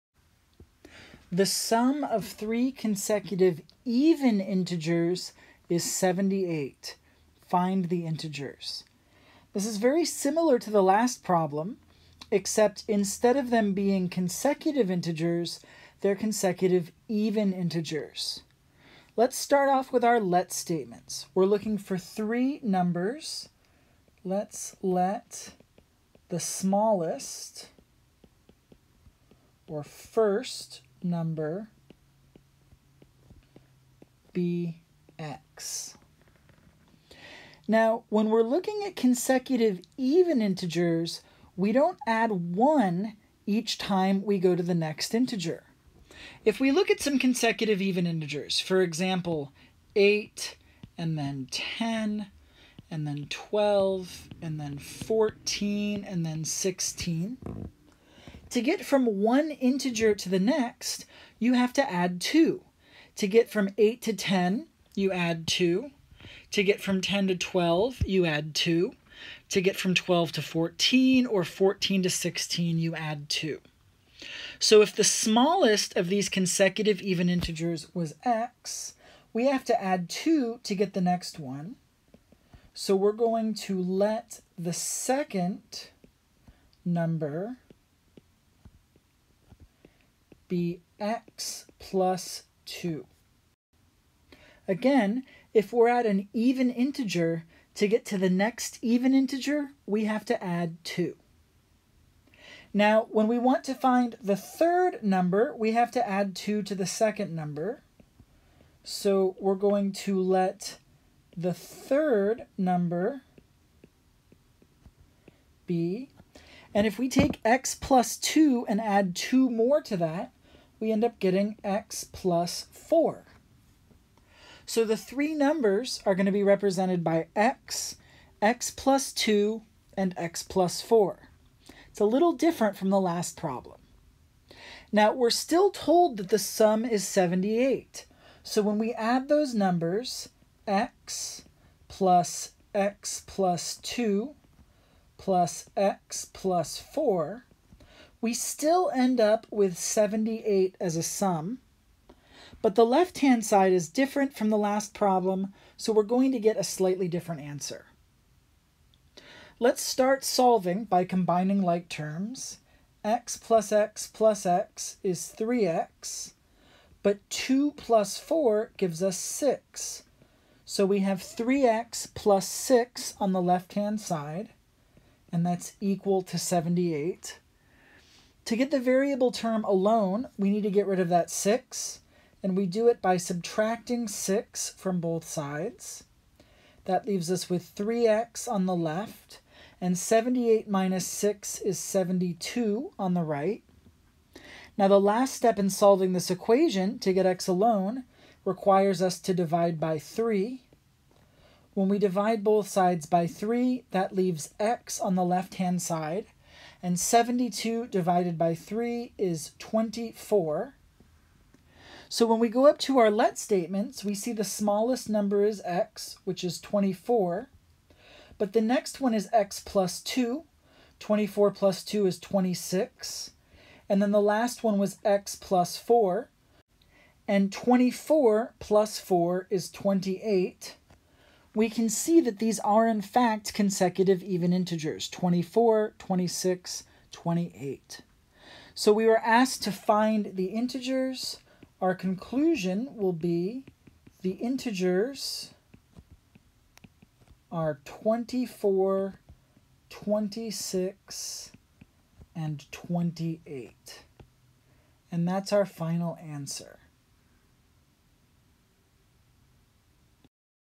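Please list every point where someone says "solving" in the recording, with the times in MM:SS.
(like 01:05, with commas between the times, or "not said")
02:40, 03:15.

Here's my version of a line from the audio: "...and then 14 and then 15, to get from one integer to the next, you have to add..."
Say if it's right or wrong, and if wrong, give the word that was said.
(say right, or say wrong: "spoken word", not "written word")
wrong: "16", not "15".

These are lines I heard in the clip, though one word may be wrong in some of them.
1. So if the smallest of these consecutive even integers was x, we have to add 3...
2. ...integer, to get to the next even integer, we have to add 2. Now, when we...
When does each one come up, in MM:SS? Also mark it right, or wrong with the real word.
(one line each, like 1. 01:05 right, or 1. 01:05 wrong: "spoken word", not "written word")
1. 01:14 wrong: "2", not "3"
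2. 01:36 right.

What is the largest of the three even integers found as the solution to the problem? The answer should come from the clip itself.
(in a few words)
28.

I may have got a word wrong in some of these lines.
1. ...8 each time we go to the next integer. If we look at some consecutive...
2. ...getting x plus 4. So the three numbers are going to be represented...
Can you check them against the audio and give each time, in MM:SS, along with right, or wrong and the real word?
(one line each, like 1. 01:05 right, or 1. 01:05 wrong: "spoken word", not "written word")
1. 00:42 wrong: "1", not "8"
2. 02:01 right.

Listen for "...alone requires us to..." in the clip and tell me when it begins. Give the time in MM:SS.
03:17.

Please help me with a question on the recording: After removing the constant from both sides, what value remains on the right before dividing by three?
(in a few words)
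72.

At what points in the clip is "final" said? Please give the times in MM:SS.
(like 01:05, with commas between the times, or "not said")
04:15.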